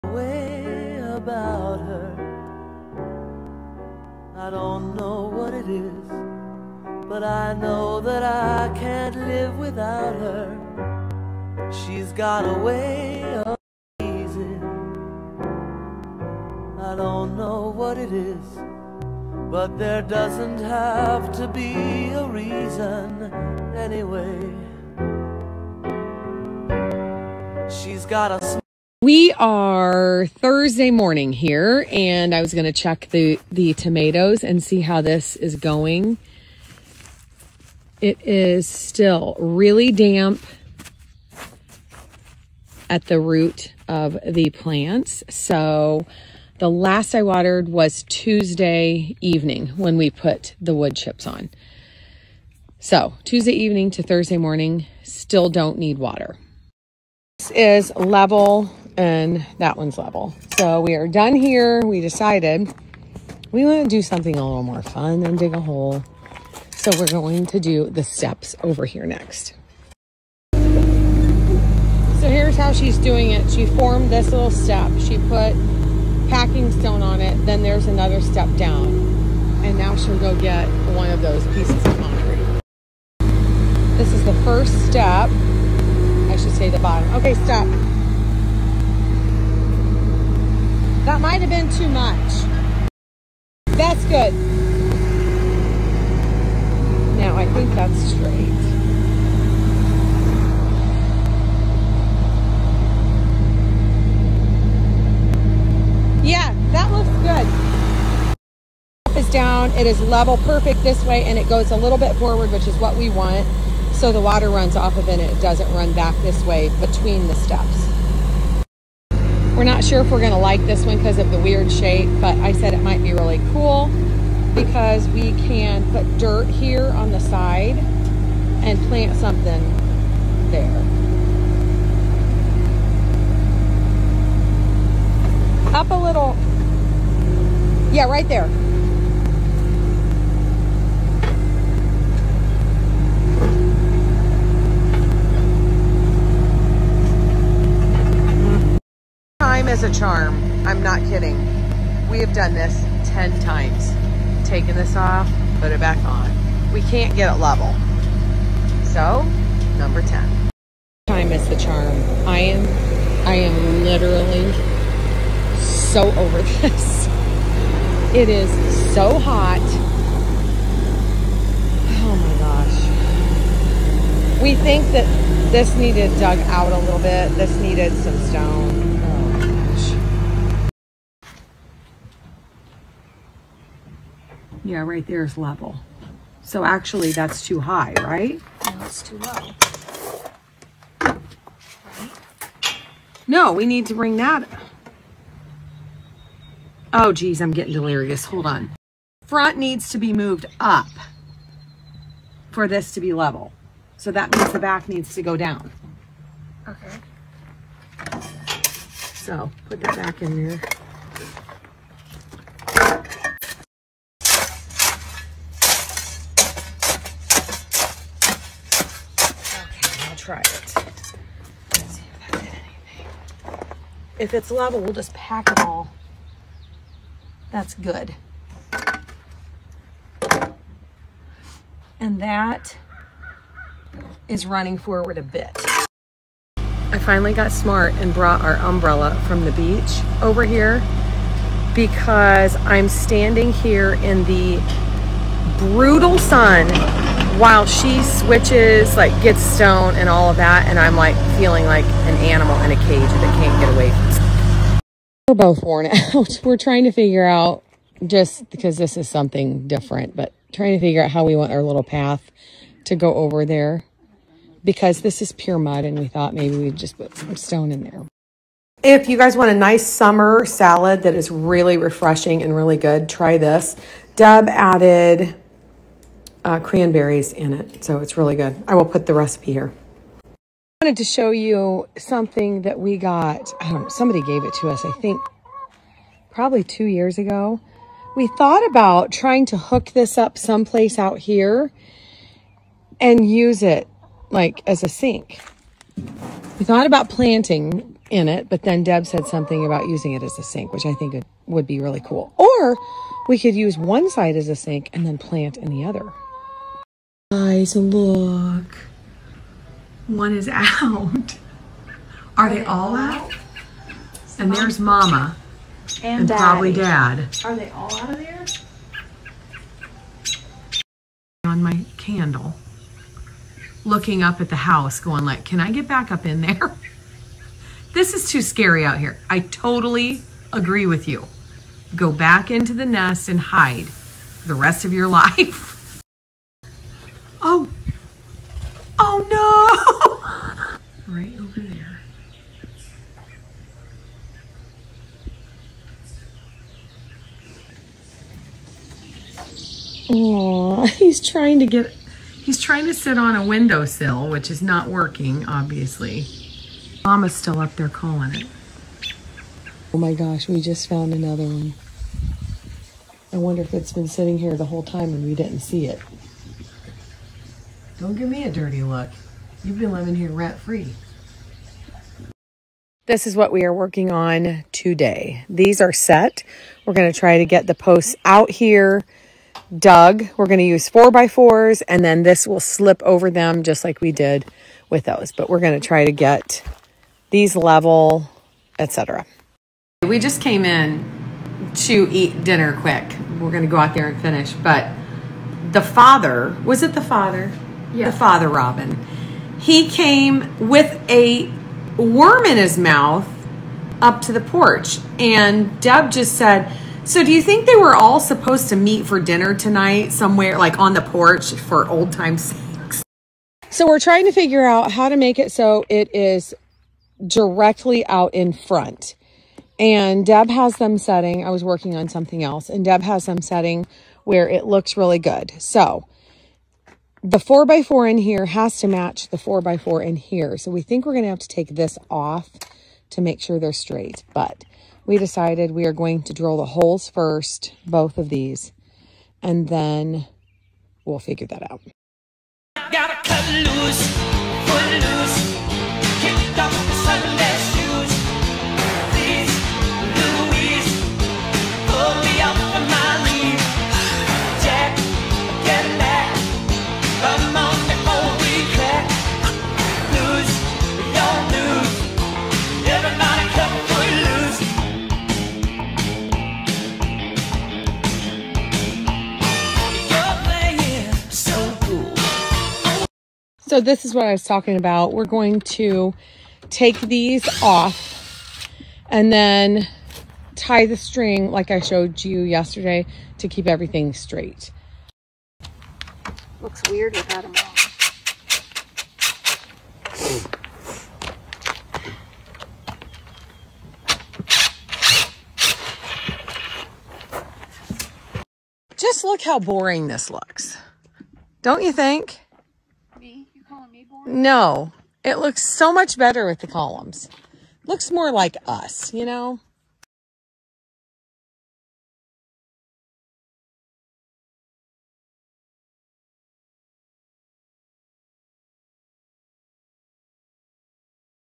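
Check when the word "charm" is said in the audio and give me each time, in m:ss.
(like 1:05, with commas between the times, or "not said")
2:29, 2:41.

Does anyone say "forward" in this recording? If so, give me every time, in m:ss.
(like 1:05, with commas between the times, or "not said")
1:52, 3:54.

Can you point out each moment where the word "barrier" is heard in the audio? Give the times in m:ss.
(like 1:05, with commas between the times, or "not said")
not said.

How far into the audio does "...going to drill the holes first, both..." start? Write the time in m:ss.
7:15.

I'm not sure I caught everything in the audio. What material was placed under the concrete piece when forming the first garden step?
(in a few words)
packing stone.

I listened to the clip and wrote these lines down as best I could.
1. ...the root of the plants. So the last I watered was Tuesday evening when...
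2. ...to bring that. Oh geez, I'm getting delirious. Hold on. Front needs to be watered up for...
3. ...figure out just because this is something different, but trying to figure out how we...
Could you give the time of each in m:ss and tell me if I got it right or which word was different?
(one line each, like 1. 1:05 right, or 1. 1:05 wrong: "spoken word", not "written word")
1. 0:43 right
2. 3:13 wrong: "moved", not "watered"
3. 4:16 right.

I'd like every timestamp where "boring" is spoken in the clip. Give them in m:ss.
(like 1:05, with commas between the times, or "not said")
8:19.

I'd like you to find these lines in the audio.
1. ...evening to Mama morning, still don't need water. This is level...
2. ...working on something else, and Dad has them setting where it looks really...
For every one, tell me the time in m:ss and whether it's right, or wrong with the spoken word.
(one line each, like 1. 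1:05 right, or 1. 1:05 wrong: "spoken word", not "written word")
1. 0:53 wrong: "Thursday", not "Mama"
2. 7:01 wrong: "Deb", not "Dad".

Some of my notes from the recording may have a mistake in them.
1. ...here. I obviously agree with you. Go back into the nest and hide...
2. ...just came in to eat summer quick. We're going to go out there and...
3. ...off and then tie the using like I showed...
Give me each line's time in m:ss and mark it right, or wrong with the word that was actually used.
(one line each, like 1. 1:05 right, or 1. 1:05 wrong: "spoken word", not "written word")
1. 5:28 wrong: "totally", not "obviously"
2. 6:30 wrong: "dinner", not "summer"
3. 7:57 wrong: "string", not "using".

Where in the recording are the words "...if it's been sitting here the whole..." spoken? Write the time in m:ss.
6:03.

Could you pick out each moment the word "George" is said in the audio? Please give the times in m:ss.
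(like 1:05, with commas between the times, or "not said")
not said.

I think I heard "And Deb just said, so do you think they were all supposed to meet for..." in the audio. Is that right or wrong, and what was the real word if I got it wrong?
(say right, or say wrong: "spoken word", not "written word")
right.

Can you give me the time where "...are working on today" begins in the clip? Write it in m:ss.
6:13.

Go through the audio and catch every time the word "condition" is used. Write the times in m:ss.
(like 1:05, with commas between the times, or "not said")
not said.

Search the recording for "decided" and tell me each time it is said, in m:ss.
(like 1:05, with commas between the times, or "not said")
1:02, 7:15.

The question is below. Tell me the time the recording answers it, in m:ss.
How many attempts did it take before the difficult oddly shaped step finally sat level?
2:33.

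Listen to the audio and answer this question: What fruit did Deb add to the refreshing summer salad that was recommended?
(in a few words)
cranberries.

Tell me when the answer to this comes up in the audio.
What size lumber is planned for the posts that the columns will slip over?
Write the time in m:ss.
6:20.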